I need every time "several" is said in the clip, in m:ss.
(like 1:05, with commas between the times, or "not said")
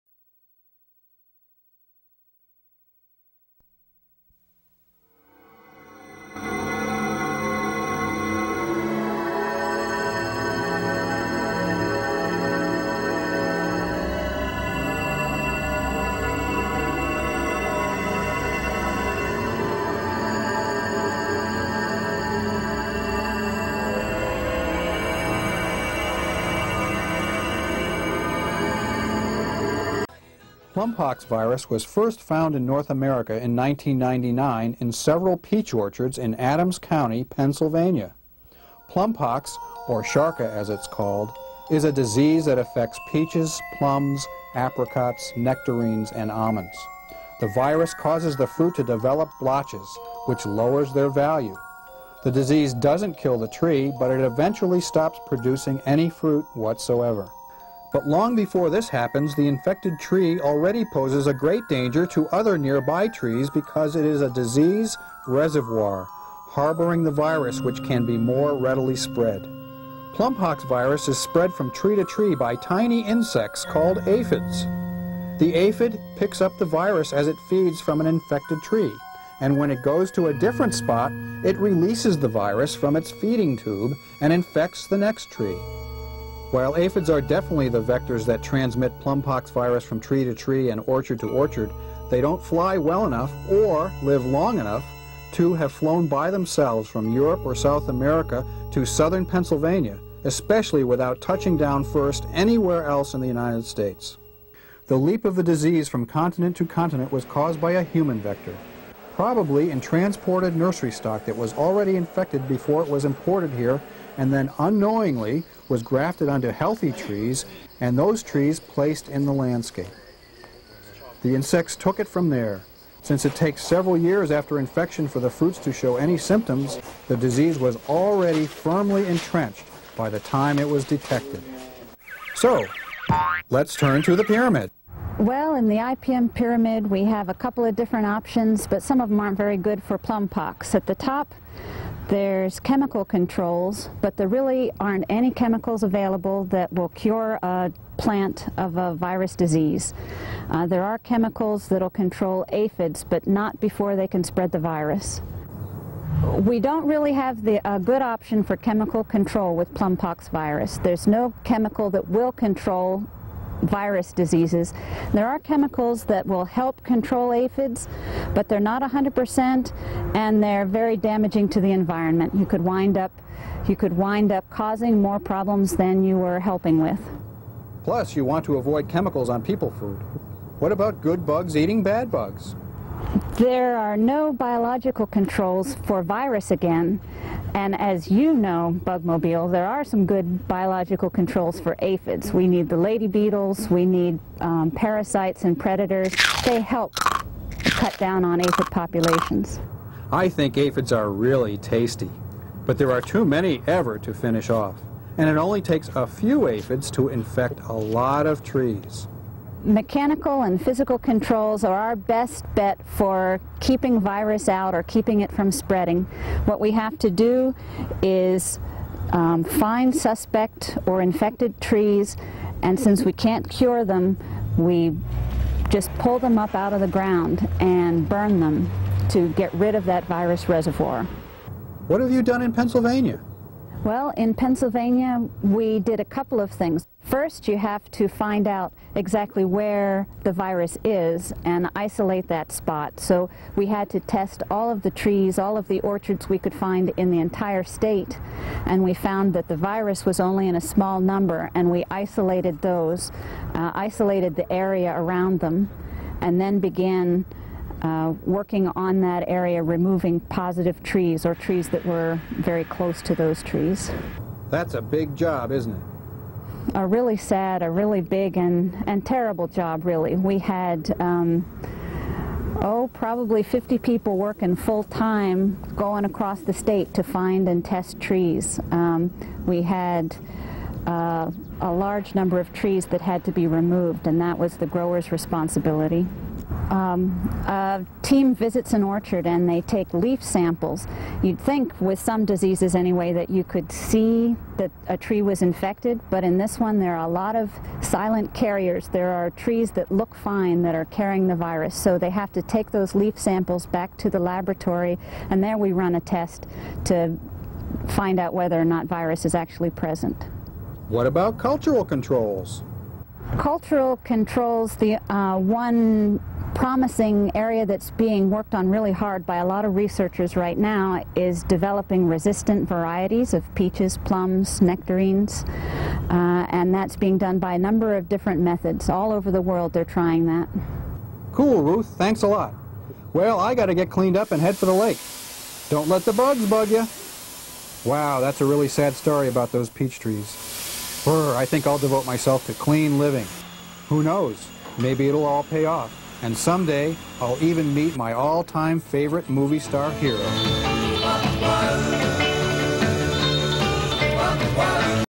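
0:34, 2:03.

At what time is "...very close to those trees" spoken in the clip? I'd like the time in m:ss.
4:22.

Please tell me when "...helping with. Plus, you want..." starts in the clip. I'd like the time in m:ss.
2:56.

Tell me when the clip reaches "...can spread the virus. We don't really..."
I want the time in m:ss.
2:34.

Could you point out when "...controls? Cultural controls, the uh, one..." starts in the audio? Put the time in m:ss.
5:11.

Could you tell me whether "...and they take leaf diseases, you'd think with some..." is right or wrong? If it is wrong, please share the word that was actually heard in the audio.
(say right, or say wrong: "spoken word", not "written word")
wrong: "samples", not "diseases".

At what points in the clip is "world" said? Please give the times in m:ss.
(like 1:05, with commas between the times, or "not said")
5:29.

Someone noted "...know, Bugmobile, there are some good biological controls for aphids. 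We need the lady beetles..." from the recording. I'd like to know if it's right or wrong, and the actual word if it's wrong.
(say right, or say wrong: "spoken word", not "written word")
right.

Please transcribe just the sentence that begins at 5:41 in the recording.
Brr, I think I'll devote myself to clean living.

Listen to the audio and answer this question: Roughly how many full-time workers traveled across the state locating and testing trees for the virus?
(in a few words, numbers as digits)
50.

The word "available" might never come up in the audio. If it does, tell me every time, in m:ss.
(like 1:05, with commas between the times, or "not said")
2:25.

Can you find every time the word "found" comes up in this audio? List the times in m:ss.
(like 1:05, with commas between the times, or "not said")
0:32, 4:08.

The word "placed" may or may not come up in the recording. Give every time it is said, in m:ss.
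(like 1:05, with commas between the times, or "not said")
1:58.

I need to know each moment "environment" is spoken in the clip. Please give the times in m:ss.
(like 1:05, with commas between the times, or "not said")
2:51.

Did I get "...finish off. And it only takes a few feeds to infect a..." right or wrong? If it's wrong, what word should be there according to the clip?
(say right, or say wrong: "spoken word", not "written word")
wrong: "aphids", not "feeds".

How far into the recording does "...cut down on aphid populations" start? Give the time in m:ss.
3:17.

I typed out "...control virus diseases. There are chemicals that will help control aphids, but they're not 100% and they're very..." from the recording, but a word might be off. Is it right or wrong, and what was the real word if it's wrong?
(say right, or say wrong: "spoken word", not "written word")
right.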